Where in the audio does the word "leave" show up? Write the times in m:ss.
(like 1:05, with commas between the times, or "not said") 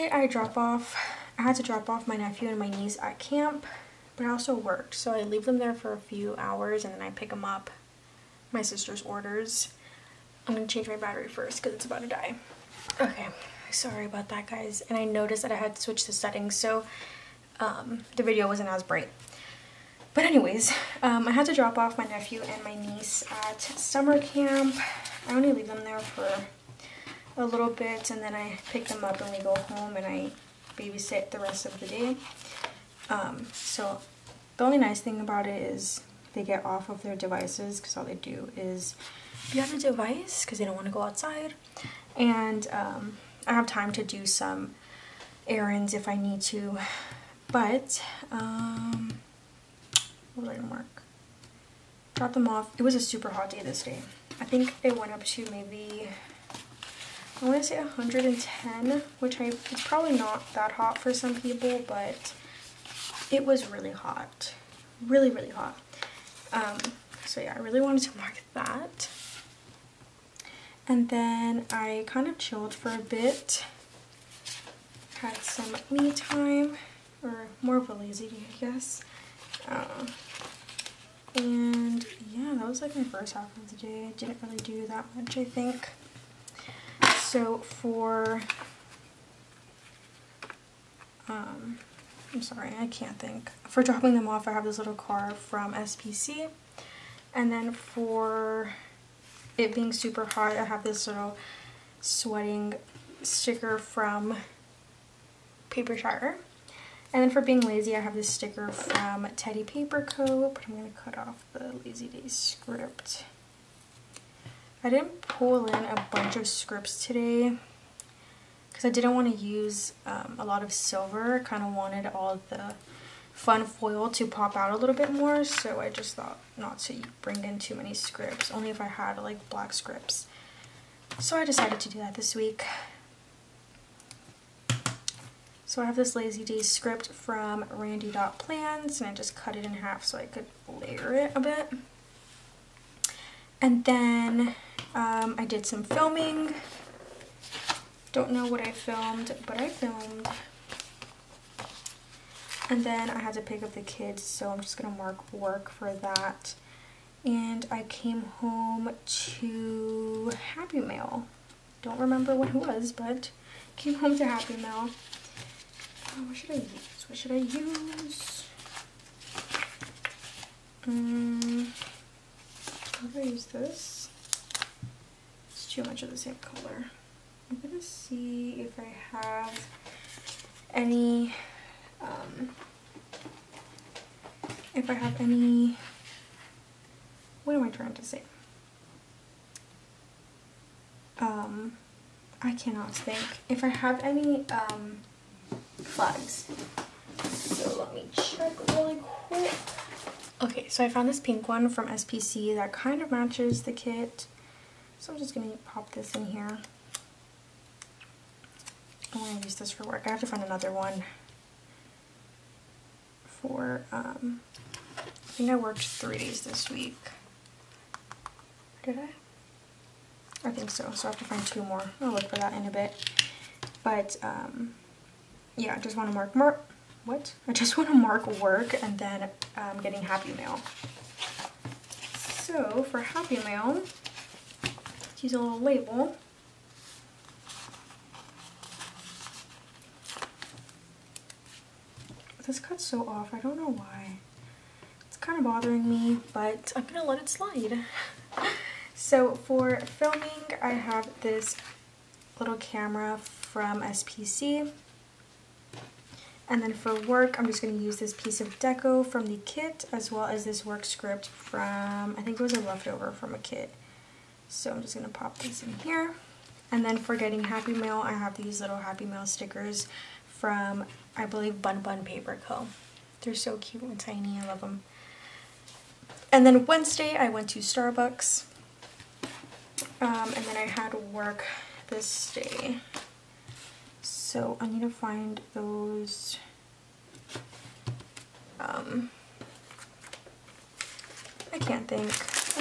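0:05, 0:25.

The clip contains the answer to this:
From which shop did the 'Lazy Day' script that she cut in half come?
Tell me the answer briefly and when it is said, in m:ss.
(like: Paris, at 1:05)
Randy Dot Plans, at 2:17.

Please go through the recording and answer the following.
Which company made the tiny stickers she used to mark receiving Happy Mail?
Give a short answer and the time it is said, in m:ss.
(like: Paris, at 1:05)
Bun Bun Paper Co, at 4:31.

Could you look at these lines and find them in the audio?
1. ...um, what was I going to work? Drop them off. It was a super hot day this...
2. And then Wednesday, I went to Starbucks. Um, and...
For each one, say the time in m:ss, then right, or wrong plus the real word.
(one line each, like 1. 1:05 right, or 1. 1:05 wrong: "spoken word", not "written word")
1. 0:48 right
2. 4:36 right.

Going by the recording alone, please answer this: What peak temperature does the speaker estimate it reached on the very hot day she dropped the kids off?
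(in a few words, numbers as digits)
110.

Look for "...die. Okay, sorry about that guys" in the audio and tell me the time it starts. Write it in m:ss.
0:12.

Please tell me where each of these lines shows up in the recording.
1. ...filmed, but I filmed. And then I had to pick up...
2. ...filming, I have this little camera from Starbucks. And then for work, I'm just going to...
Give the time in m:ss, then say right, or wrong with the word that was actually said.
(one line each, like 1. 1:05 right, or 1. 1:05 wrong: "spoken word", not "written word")
1. 2:28 right
2. 4:09 wrong: "SPC", not "Starbucks".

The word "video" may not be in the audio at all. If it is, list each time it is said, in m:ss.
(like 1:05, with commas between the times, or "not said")
0:18.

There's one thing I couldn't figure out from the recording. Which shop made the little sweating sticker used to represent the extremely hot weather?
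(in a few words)
Papershire.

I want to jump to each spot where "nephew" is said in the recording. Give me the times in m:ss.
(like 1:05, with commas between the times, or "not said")
0:02, 0:22.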